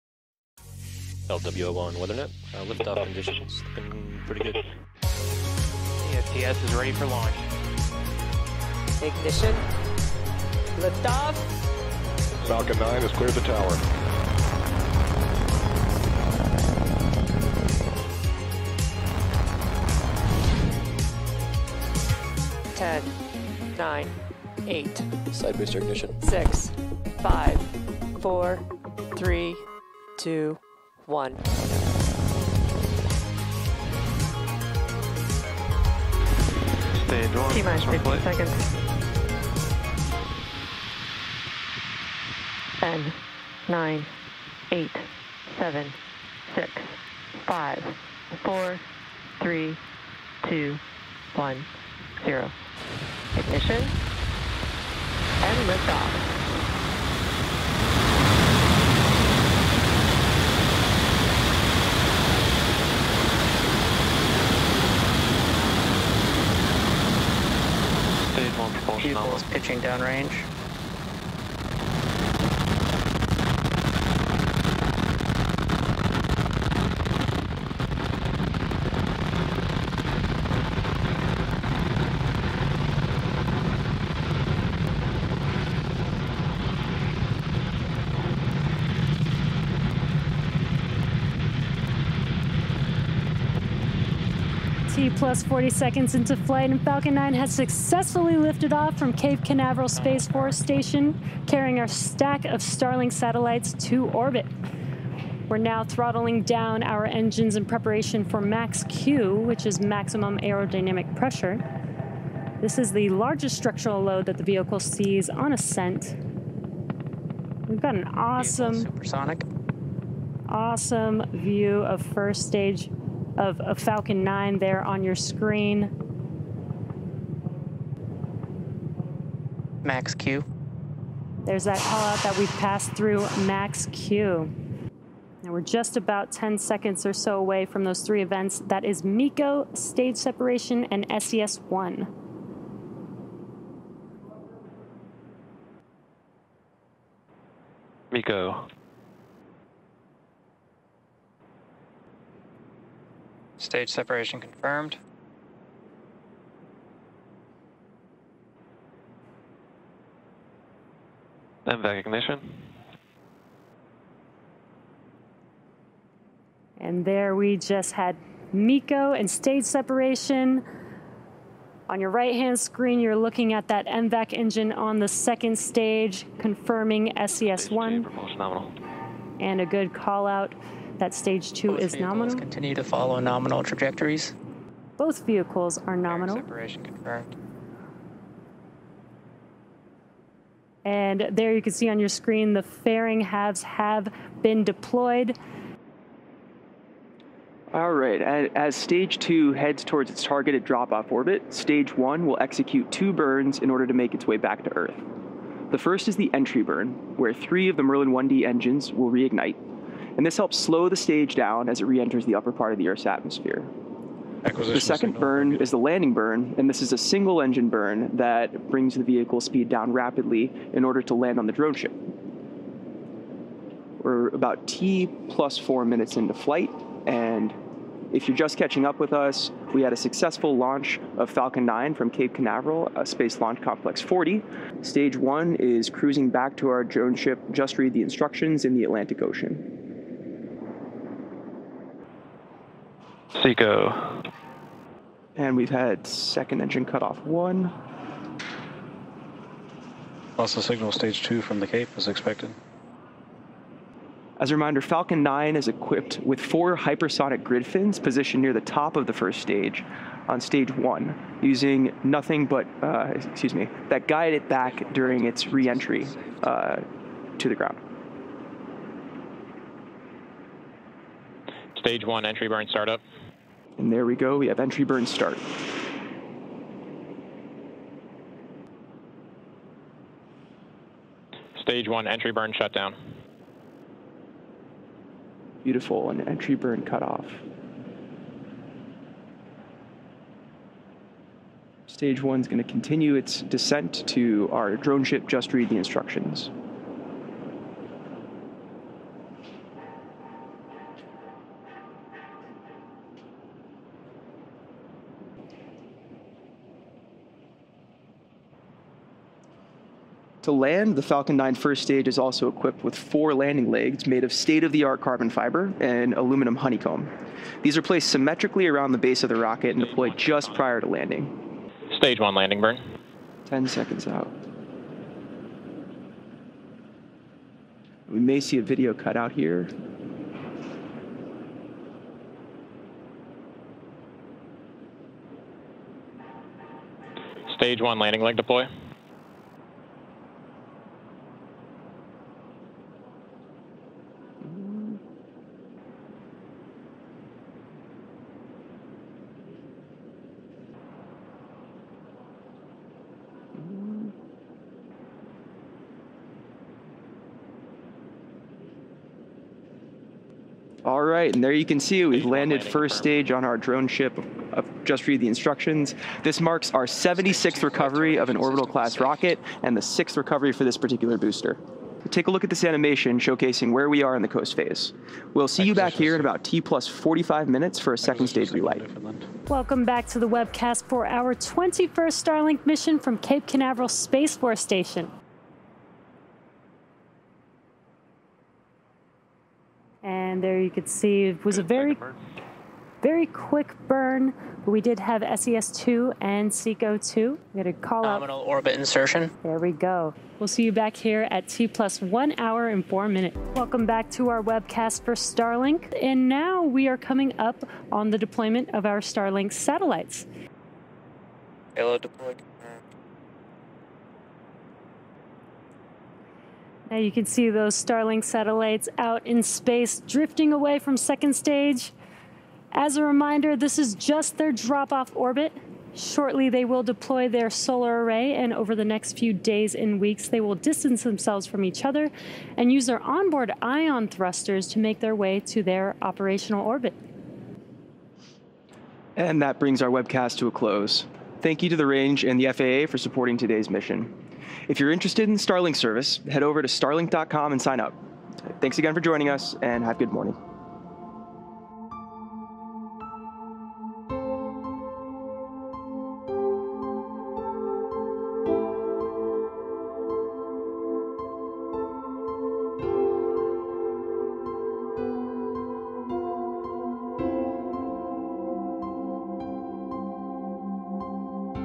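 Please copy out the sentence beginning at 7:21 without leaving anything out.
Thank you to the range and the FAA for supporting today's mission.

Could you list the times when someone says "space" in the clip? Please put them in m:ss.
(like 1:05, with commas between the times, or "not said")
1:39, 3:53, 6:23, 6:59.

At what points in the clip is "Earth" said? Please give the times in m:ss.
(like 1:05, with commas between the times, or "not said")
3:24, 3:32.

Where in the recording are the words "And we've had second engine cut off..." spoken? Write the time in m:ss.
4:05.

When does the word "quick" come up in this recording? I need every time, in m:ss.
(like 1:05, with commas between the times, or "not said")
6:33.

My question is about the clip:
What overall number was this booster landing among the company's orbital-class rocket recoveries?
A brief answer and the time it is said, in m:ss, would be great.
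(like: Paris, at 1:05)
76th, at 6:06.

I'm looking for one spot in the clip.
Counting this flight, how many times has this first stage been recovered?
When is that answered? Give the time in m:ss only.
6:09.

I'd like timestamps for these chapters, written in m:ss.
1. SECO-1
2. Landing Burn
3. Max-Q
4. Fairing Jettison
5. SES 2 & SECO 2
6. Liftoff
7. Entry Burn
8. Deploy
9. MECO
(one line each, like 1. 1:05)
1. 4:04
2. 5:24
3. 2:12
4. 3:03
5. 6:28
6. 0:58
7. 4:32
8. 6:57
9. 2:30.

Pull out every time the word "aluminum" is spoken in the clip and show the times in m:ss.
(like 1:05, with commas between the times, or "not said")
5:16.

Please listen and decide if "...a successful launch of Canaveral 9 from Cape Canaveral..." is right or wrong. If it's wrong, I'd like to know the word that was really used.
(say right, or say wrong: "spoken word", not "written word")
wrong: "Falcon", not "Canaveral".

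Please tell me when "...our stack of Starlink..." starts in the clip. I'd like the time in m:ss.
1:41.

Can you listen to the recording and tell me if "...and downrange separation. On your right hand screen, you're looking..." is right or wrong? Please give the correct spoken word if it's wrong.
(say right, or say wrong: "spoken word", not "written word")
wrong: "stage", not "downrange".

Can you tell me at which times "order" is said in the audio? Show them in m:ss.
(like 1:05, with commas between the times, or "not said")
3:23, 3:40.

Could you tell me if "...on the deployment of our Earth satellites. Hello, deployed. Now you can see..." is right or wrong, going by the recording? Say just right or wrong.
wrong.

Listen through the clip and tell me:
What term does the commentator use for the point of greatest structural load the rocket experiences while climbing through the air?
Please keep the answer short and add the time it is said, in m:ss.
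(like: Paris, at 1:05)
Maximum aerodynamic pressure, at 1:49.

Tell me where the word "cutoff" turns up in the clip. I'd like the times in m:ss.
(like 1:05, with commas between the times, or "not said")
4:46.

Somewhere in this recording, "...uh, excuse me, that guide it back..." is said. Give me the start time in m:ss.
4:22.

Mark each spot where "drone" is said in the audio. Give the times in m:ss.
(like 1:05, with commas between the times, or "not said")
3:41, 3:56, 4:54, 6:03.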